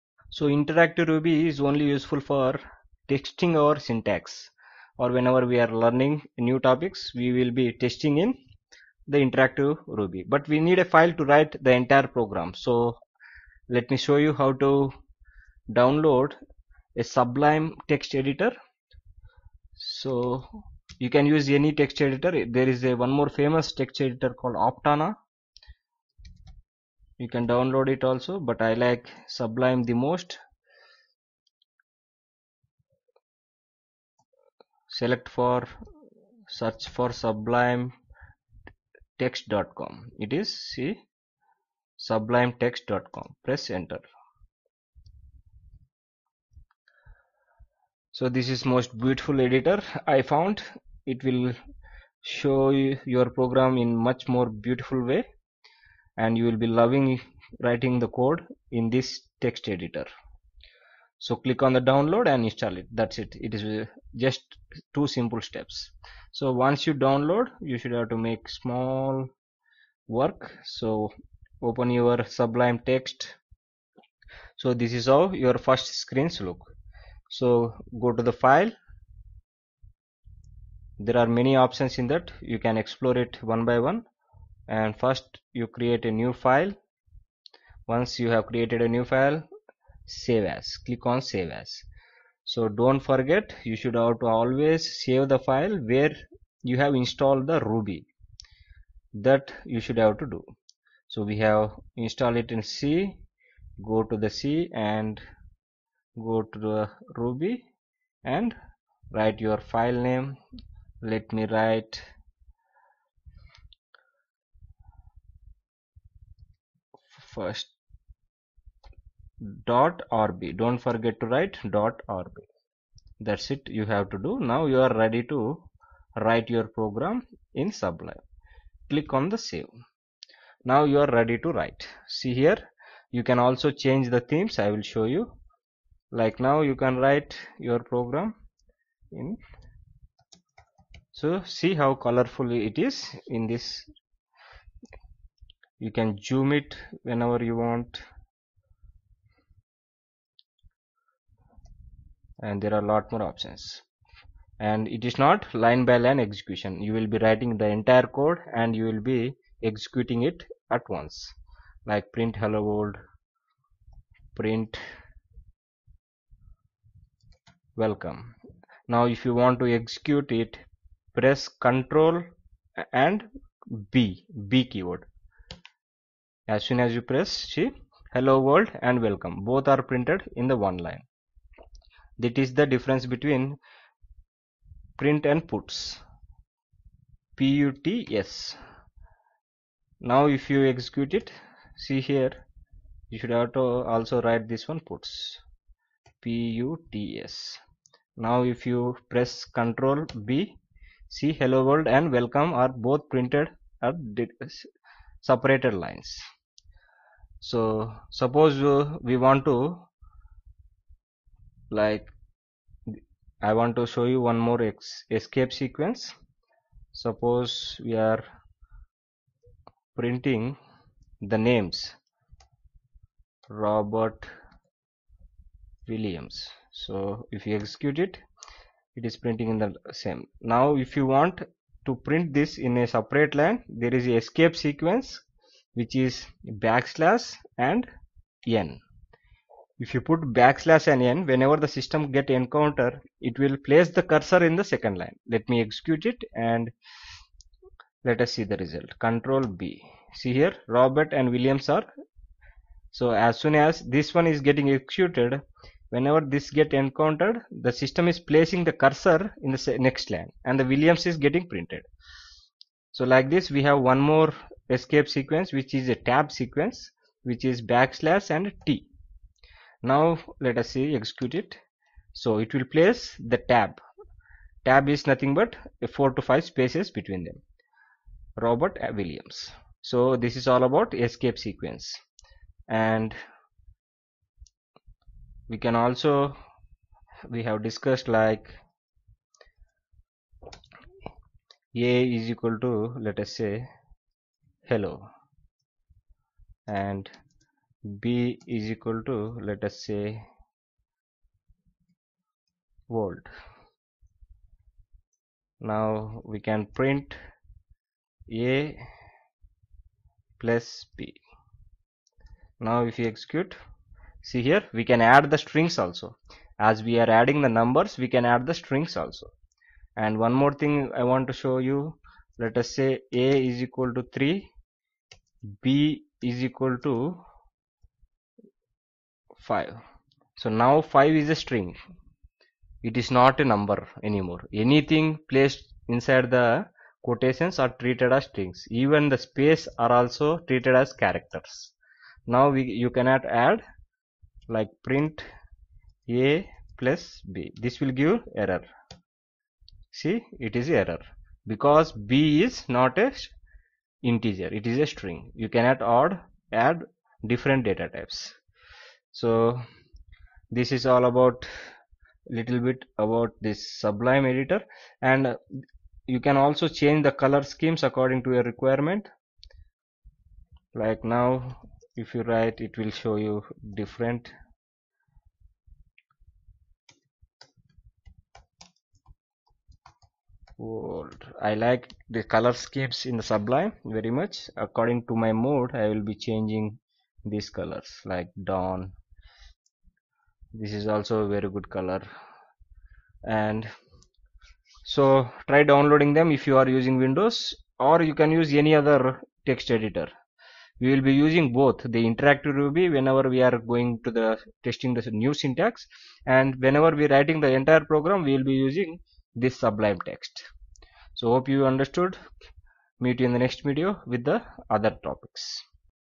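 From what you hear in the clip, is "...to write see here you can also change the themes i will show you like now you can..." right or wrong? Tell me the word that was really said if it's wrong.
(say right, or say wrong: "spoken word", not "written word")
right.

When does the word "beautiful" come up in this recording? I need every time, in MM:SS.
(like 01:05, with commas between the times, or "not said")
00:49, 00:54.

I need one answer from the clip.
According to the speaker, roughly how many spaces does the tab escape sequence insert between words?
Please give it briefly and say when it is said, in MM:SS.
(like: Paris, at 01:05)
4 to 5, at 04:35.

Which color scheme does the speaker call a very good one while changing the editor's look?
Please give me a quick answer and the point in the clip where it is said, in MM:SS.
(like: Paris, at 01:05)
Dawn, at 06:28.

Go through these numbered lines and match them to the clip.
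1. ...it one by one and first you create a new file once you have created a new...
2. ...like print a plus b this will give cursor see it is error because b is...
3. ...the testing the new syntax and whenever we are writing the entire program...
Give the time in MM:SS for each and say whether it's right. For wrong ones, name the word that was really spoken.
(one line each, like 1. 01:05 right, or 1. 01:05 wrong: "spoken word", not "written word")
1. 01:23 right
2. 05:44 wrong: "error", not "cursor"
3. 06:44 right.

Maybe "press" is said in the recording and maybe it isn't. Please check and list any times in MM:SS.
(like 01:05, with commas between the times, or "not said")
00:43, 02:51, 02:57, 03:19.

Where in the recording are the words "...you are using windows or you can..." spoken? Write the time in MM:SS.
06:36.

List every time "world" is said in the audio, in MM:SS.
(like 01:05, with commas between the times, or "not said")
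02:42, 02:58, 03:21, 05:02, 06:20.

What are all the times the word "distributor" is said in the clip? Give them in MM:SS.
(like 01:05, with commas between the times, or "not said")
not said.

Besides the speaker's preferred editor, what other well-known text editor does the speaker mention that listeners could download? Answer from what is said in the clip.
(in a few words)
Aptana.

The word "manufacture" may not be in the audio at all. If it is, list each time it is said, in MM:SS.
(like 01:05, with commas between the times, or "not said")
not said.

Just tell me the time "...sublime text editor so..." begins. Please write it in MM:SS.
00:17.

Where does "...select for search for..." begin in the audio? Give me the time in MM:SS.
00:34.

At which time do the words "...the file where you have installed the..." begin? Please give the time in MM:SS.
01:35.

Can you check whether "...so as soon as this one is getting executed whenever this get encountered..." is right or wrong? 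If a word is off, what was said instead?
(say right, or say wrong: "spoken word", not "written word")
right.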